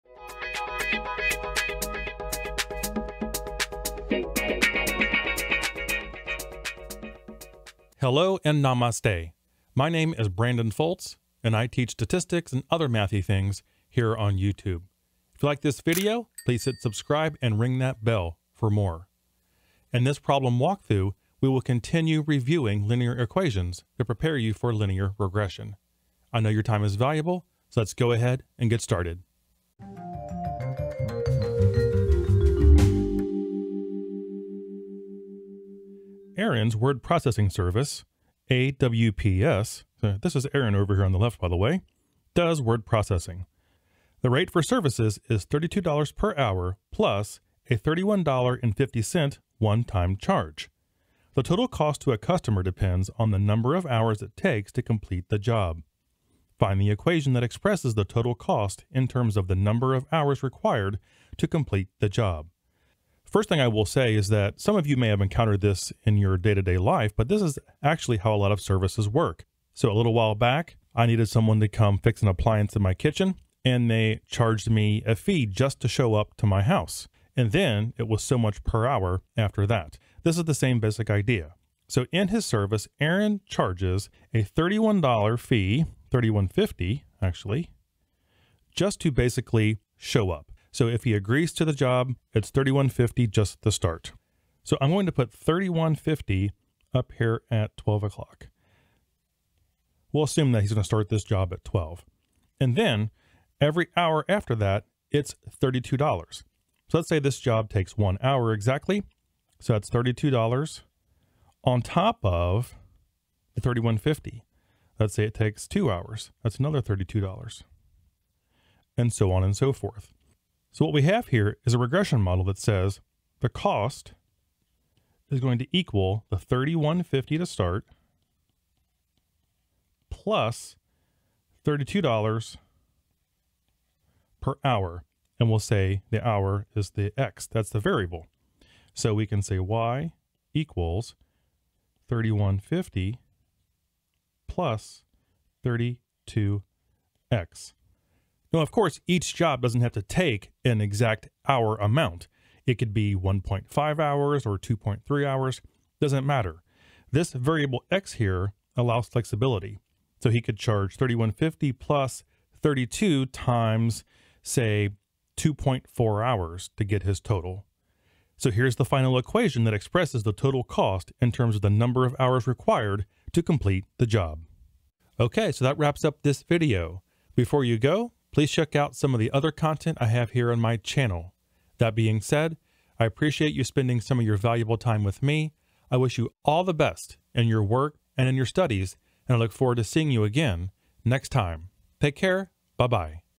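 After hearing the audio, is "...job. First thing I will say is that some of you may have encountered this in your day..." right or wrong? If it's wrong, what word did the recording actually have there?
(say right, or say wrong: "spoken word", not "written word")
right.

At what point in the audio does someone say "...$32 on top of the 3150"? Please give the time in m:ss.
1:49.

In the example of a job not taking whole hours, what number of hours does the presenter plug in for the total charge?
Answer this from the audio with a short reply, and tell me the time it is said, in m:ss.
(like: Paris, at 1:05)
2.4 hours, at 2:45.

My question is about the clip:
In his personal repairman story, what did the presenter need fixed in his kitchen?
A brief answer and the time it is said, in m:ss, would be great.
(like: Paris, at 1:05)
an appliance, at 1:12.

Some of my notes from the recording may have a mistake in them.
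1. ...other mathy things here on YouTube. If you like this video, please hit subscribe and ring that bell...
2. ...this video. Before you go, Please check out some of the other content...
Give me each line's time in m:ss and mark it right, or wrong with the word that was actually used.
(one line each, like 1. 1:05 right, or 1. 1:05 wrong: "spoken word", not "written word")
1. 0:12 right
2. 2:56 right.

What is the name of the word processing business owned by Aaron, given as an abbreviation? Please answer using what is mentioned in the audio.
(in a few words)
AWPS.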